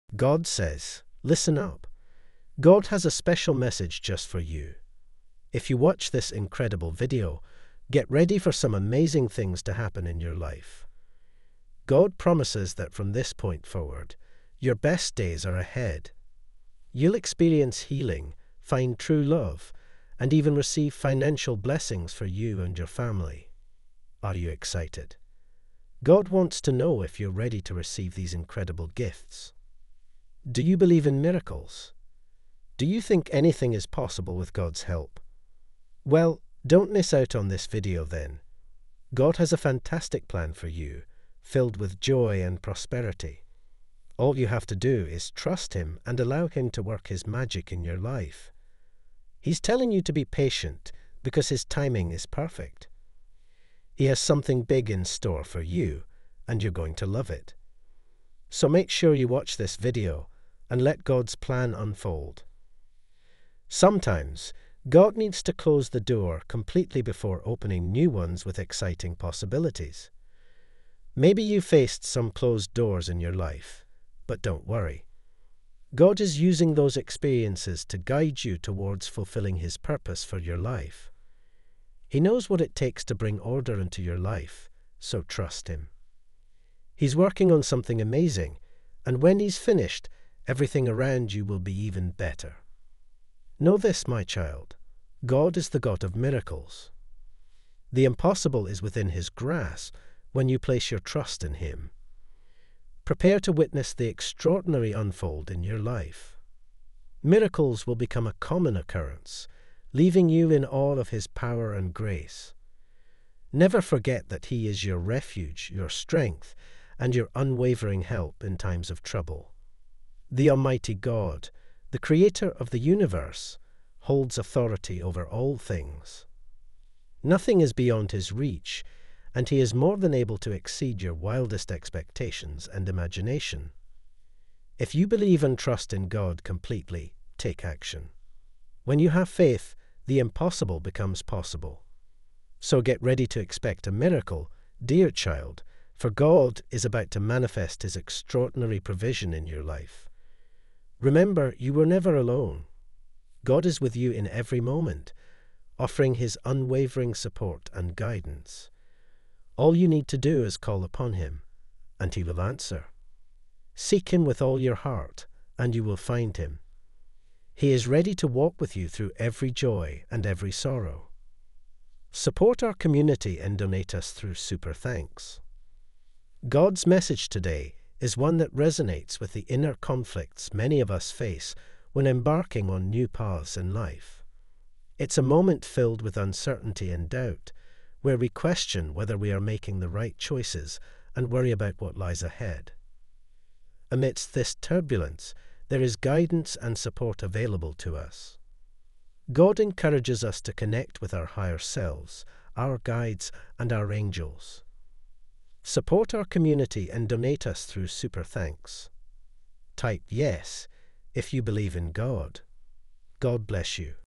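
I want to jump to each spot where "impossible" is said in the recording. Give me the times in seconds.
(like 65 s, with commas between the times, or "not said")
98 s, 140 s.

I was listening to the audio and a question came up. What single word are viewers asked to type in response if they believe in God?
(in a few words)
yes.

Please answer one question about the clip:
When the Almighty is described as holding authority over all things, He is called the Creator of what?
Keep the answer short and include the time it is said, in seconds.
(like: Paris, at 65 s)
the universe, at 122 s.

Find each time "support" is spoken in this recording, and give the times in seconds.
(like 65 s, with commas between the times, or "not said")
157 s, 172 s, 196 s, 205 s.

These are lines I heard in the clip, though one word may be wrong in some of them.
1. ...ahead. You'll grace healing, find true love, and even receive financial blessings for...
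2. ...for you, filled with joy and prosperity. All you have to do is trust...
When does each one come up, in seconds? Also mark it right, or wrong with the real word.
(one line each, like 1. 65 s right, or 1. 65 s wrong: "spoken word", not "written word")
1. 15 s wrong: "experience", not "grace"
2. 40 s right.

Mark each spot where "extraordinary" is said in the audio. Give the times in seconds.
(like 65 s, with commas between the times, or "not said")
104 s, 147 s.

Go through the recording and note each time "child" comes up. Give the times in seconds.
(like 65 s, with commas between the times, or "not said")
94 s, 145 s.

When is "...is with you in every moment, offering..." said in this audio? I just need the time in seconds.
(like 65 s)
153 s.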